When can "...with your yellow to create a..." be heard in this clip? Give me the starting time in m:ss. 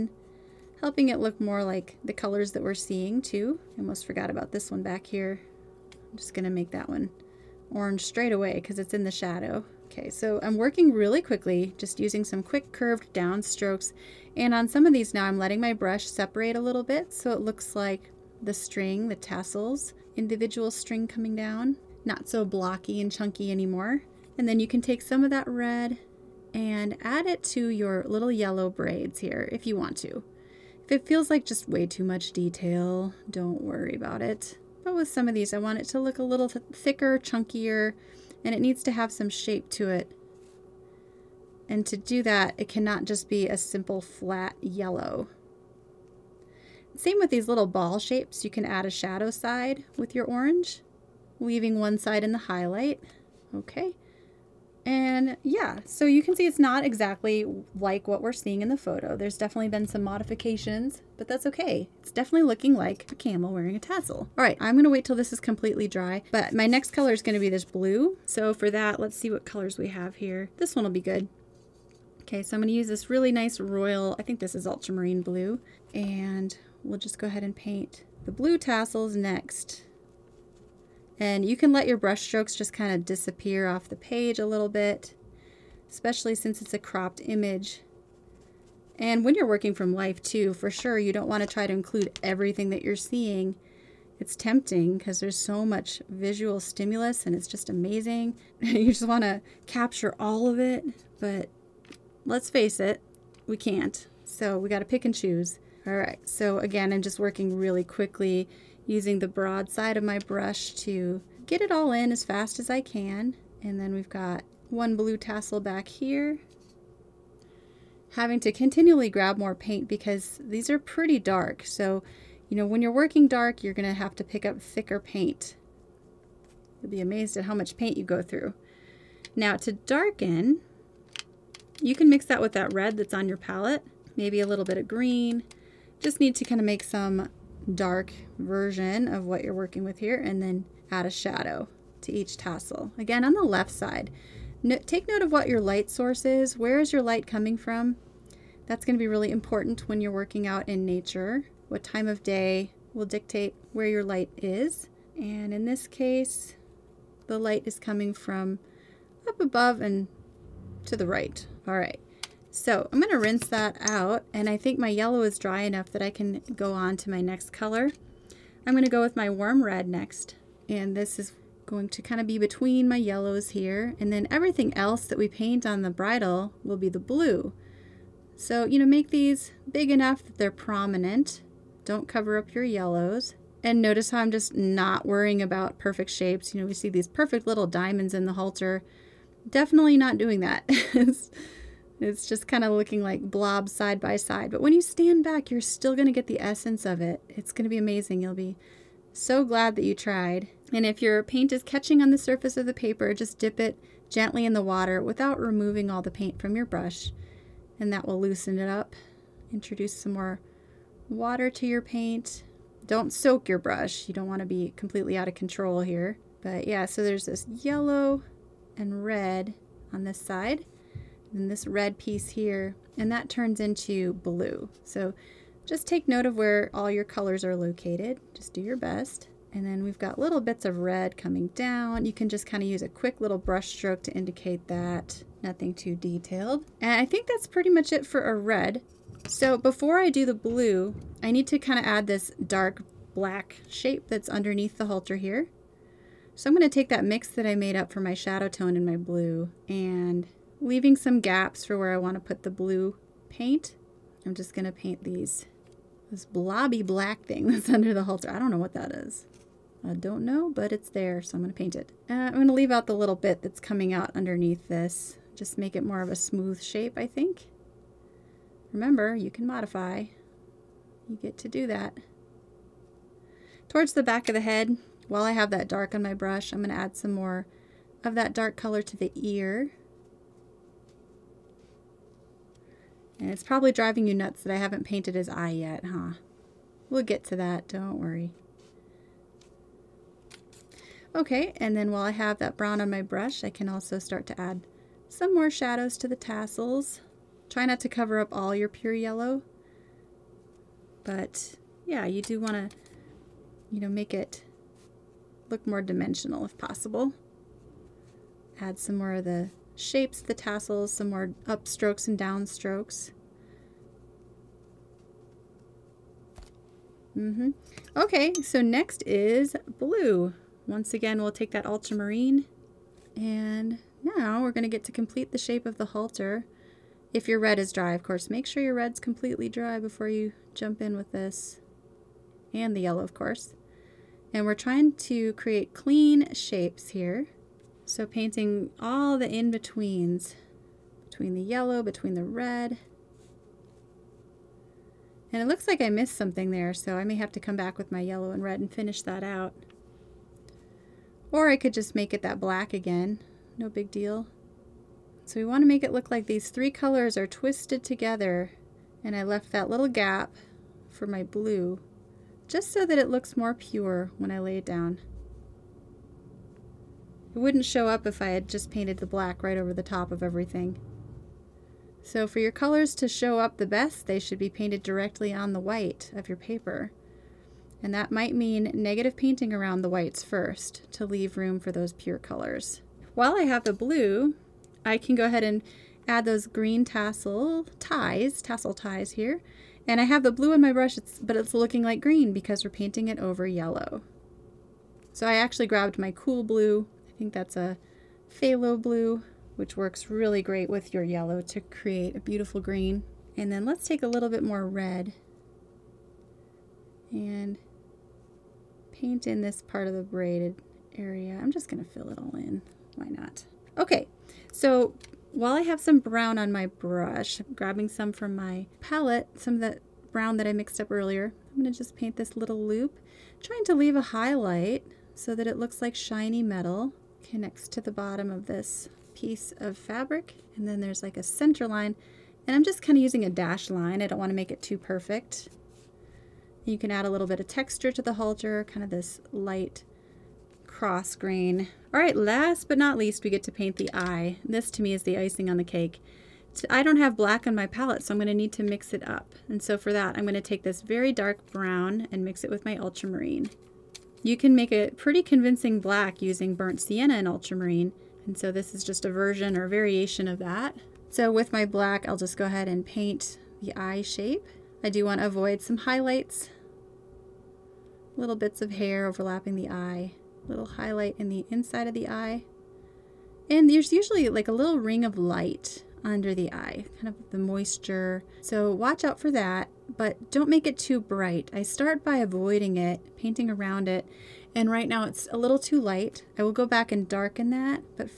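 6:40.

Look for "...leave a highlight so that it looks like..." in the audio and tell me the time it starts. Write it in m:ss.
7:03.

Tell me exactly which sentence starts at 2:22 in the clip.
Again, on the left side, no, take note of what your light source is.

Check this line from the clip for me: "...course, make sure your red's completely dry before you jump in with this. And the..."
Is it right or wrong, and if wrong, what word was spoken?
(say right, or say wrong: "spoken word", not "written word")
right.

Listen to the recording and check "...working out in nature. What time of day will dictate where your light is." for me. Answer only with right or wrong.
right.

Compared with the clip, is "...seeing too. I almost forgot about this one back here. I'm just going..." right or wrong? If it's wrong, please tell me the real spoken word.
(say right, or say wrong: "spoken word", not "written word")
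right.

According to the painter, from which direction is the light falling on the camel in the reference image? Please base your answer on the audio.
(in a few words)
up above and to the right.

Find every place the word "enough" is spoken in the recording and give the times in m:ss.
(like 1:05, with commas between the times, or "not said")
2:45, 2:59.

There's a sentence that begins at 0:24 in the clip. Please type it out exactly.
And then you can take some of that red and add it to your little yellow braids here if you want to.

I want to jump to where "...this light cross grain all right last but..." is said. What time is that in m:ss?
7:18.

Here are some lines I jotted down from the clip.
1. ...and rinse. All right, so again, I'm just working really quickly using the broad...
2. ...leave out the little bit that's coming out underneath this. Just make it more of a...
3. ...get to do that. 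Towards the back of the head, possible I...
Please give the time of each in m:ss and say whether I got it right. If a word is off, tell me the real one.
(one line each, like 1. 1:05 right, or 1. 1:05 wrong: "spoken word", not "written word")
1. 1:45 wrong: "choose", not "rinse"
2. 4:22 right
3. 4:31 wrong: "while", not "possible".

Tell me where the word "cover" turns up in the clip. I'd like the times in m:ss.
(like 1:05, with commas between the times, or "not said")
3:02, 4:57.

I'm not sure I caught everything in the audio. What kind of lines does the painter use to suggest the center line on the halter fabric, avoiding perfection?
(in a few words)
dash line.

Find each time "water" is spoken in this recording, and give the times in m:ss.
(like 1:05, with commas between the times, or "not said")
3:24, 3:31.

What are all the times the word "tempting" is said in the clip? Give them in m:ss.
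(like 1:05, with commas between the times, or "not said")
1:34.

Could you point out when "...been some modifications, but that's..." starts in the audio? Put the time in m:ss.
0:59.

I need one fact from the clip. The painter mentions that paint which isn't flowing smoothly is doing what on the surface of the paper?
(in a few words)
catching.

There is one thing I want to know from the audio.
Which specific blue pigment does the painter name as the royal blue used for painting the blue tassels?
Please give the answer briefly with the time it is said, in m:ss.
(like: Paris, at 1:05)
ultramarine blue, at 1:14.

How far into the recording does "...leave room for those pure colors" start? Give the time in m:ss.
6:21.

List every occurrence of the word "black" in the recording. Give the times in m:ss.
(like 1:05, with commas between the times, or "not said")
4:03, 4:16, 5:52, 6:09, 7:27, 7:35, 7:41.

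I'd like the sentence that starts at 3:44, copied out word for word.
So just take note of where all your colors are located.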